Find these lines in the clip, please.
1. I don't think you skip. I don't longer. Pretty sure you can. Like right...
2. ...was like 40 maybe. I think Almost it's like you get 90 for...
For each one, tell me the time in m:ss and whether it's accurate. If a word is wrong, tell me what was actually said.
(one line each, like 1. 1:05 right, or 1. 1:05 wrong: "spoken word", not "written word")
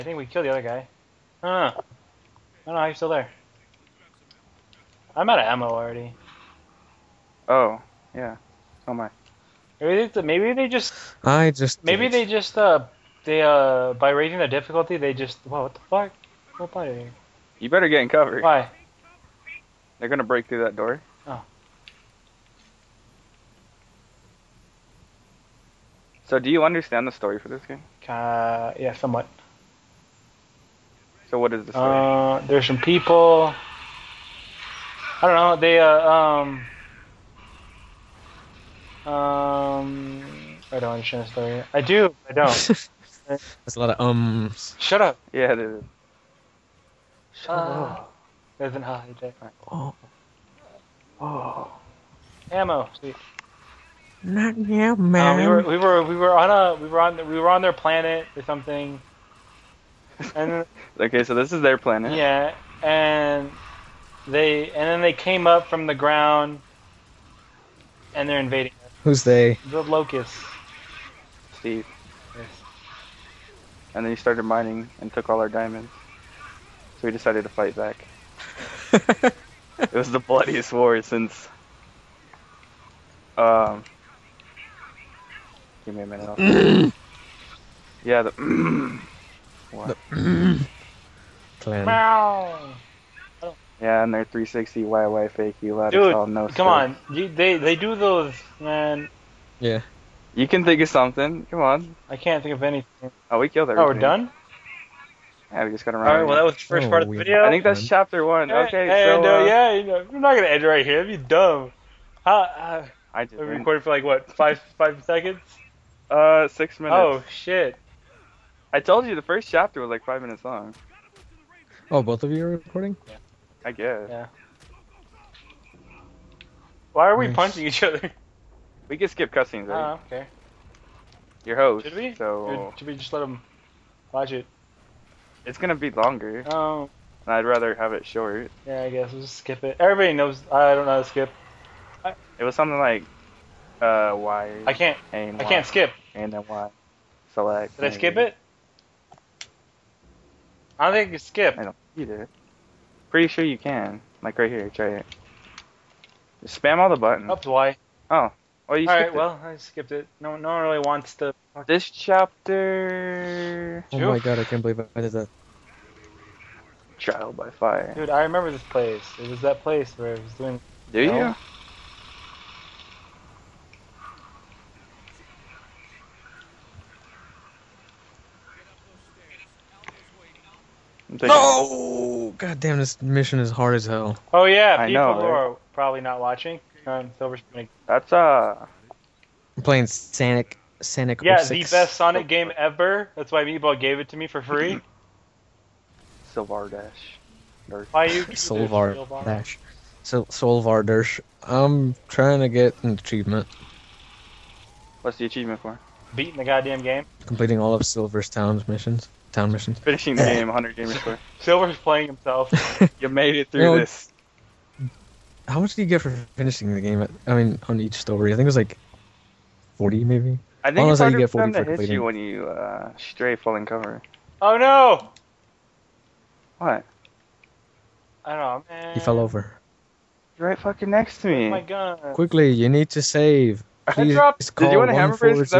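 1. 2:30 wrong: "either", not "longer"
2. 3:38 wrong: "40", not "90".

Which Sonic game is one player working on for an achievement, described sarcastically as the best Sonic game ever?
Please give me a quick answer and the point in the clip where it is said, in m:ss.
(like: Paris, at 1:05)
Sonic 06, at 3:11.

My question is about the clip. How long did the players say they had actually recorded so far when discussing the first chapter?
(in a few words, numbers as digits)
6 minutes.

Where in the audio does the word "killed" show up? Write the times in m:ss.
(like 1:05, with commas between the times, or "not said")
0:00, 1:43.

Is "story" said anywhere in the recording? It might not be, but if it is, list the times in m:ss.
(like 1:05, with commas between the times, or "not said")
0:27, 0:31, 0:41, 3:37.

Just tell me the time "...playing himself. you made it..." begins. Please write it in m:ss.
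3:31.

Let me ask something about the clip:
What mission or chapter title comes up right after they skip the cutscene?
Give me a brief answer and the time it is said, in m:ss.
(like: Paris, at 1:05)
Trial by fire, at 2:46.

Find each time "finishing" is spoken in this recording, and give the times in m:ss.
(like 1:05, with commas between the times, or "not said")
3:29, 3:36.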